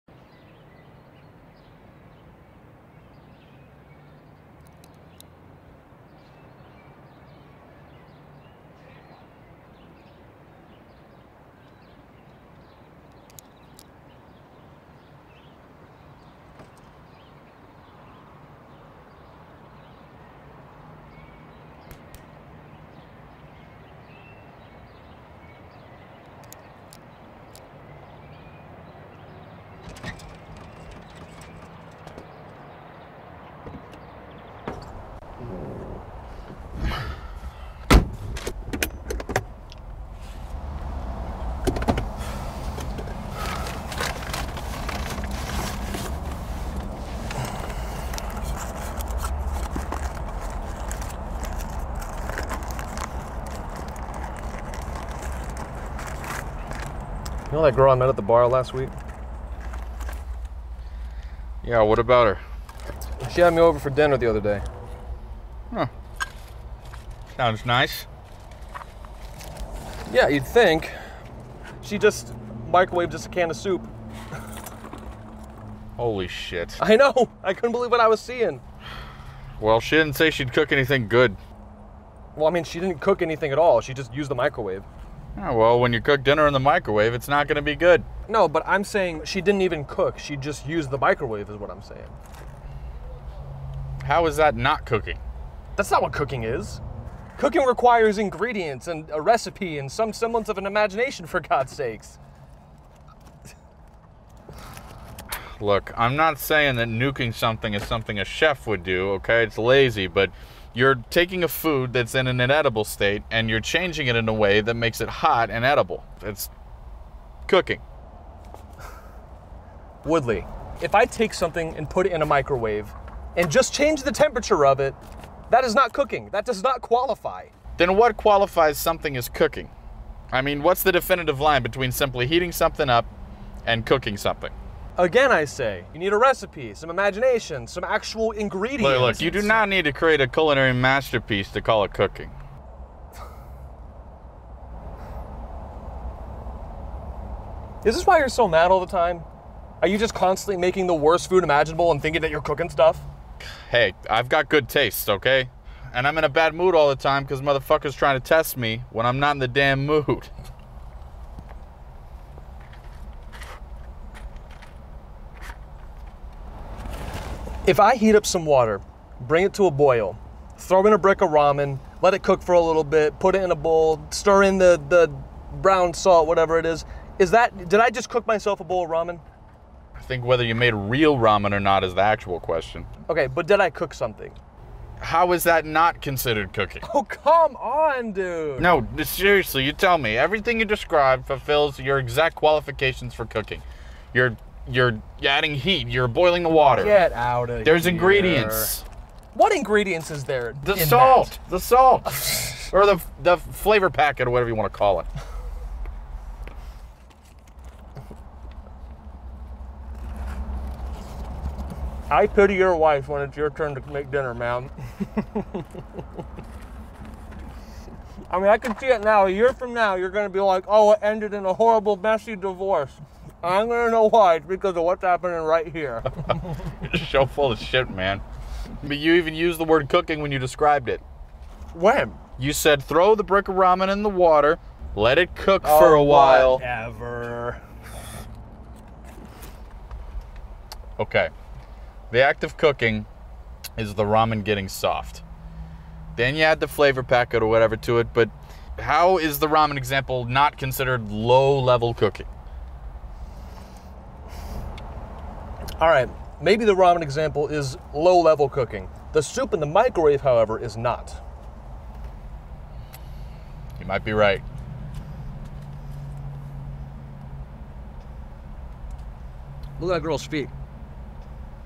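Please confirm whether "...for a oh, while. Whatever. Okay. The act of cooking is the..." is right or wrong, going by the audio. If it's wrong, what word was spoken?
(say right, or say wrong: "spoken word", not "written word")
right.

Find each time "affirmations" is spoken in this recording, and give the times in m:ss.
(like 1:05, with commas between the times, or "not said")
not said.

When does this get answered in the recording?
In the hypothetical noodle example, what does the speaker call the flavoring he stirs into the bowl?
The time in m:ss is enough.
2:54.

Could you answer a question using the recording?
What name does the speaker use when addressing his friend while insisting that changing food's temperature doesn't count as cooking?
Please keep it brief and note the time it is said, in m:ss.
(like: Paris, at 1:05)
Woodley, at 2:00.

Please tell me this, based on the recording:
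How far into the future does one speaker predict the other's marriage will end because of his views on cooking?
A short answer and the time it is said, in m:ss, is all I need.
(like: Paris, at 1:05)
a year, at 3:39.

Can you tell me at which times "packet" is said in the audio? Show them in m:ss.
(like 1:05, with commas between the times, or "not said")
3:23, 4:07.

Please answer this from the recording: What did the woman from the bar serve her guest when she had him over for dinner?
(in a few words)
a can of soup.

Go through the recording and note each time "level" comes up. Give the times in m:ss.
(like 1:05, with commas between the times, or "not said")
4:11, 4:18.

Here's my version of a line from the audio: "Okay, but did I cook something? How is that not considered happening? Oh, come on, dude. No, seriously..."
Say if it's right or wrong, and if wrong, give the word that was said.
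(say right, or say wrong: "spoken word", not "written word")
wrong: "cooking", not "happening".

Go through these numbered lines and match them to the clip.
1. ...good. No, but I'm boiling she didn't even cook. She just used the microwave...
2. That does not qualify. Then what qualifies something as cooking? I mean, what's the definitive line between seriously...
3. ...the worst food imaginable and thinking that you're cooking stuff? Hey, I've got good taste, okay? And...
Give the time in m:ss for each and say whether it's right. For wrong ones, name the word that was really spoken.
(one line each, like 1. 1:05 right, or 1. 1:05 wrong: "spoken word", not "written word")
1. 1:27 wrong: "saying", not "boiling"
2. 2:06 wrong: "simply", not "seriously"
3. 2:30 right.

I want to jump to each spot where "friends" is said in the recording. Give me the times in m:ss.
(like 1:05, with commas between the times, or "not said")
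not said.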